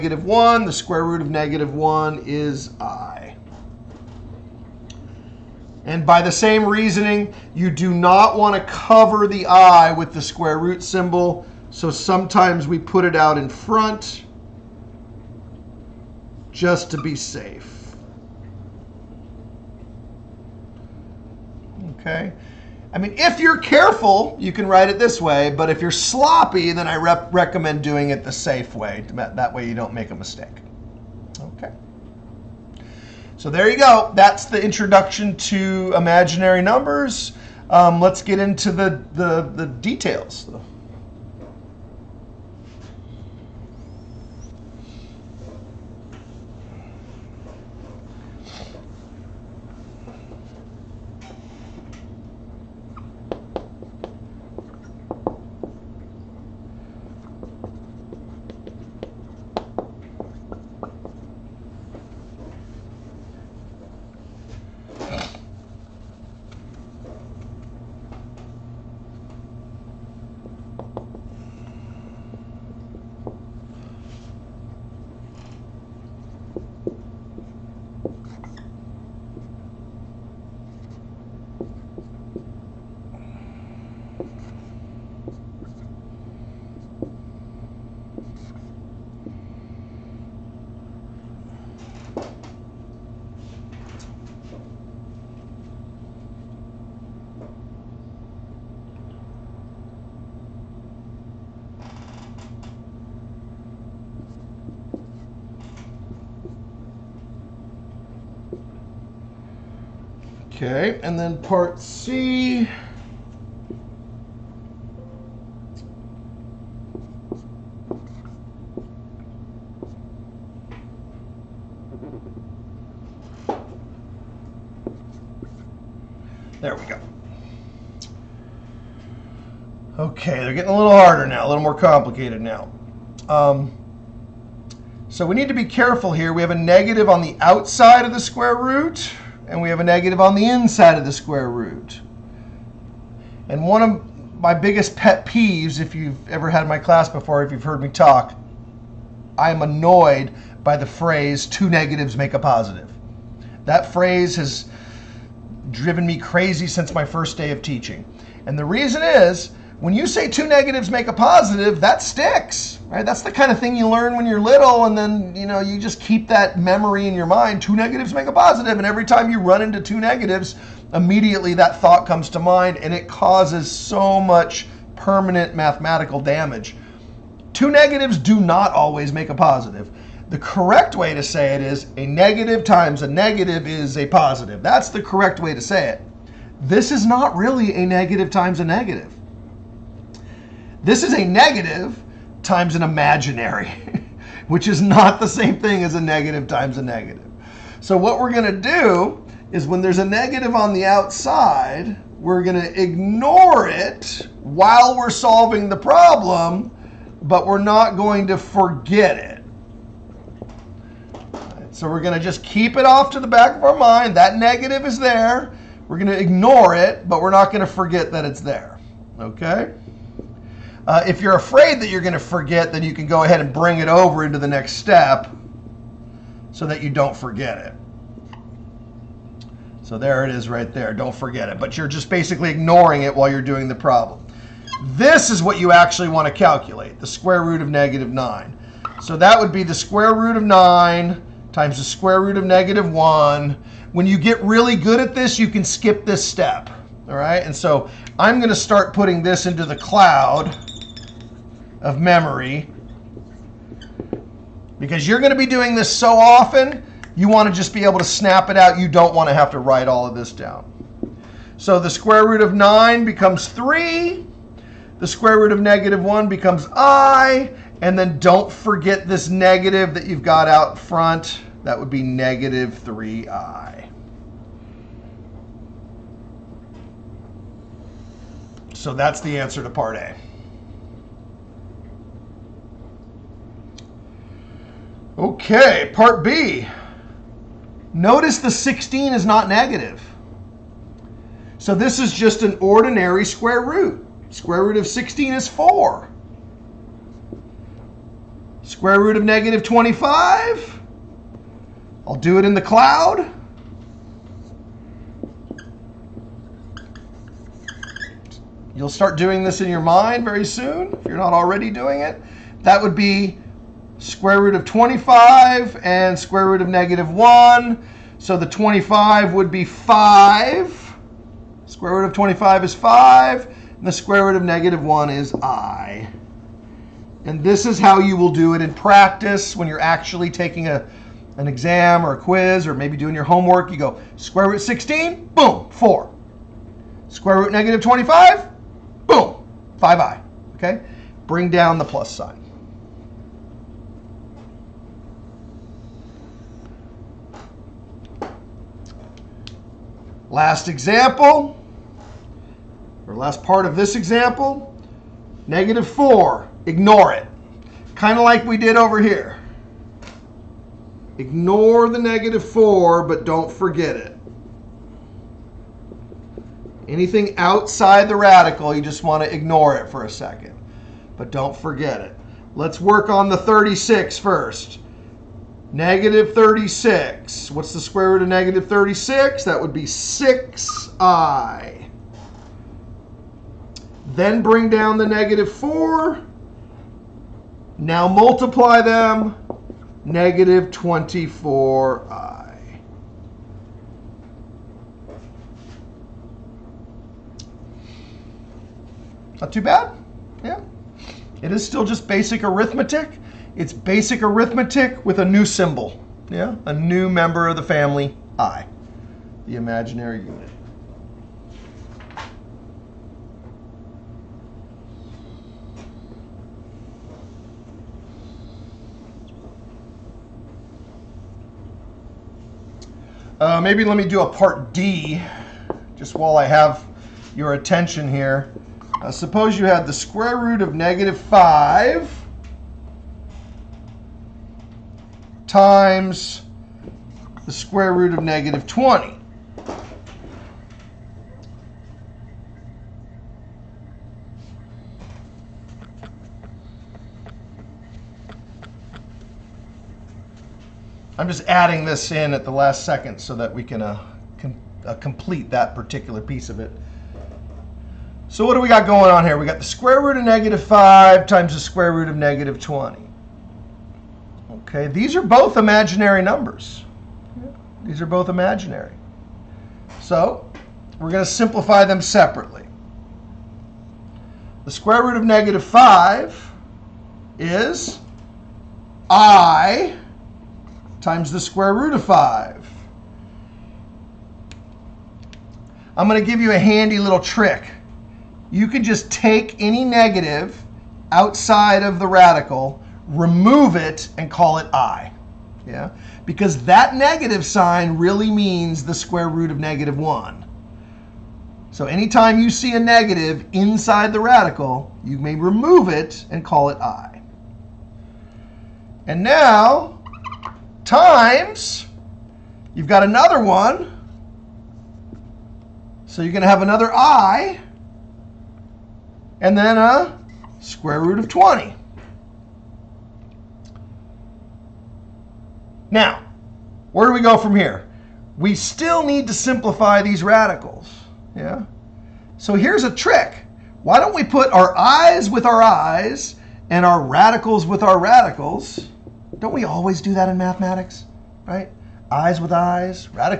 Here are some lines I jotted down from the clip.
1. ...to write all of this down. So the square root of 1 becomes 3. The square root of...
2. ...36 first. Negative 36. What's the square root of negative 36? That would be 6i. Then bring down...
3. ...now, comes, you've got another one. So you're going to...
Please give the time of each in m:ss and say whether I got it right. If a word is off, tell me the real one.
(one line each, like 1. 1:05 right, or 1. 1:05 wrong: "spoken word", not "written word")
1. 4:19 wrong: "9", not "1"
2. 6:13 right
3. 8:29 wrong: "times", not "comes".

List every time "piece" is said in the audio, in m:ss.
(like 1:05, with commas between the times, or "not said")
7:36.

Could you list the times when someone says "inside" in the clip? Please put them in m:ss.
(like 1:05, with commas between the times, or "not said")
2:20, 8:23.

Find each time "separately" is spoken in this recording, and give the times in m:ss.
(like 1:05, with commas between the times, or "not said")
7:52.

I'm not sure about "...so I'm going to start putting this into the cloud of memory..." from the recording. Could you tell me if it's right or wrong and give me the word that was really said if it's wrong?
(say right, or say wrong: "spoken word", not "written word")
right.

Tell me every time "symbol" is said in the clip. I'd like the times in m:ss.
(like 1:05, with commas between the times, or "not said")
0:10, 6:45.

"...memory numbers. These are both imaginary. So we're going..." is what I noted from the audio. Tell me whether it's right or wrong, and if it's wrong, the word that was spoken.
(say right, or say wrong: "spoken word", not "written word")
wrong: "imaginary", not "memory".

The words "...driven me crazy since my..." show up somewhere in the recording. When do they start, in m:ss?
2:35.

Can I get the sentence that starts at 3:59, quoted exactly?
So that would be the square root of 9 times the square root of negative 1.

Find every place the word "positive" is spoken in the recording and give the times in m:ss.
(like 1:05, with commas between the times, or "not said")
2:32, 2:41, 2:48, 2:59, 3:04.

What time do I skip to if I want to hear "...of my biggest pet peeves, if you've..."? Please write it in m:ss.
2:23.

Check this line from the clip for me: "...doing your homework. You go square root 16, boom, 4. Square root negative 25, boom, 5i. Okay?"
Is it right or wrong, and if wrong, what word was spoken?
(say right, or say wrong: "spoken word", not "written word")
right.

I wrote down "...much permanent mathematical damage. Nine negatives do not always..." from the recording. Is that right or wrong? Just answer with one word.
wrong.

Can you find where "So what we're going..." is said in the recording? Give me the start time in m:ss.
3:17.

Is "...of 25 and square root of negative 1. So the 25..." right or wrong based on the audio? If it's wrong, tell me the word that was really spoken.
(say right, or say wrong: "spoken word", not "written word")
right.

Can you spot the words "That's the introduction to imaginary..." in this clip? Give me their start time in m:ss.
0:34.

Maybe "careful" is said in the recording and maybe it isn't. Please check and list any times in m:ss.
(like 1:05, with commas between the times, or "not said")
0:23, 2:15.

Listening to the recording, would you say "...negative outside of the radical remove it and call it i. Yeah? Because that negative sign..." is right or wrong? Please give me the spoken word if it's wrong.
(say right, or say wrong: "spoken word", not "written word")
right.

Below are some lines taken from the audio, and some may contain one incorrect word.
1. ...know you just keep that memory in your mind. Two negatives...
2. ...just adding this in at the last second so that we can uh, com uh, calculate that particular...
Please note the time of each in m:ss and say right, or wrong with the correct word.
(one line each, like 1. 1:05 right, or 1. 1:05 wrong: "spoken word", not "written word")
1. 2:45 right
2. 7:31 wrong: "complete", not "calculate".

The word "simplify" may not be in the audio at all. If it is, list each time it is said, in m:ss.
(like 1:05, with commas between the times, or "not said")
7:51, 8:49.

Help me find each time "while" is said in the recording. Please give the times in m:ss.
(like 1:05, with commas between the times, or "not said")
3:24, 3:53, 7:06.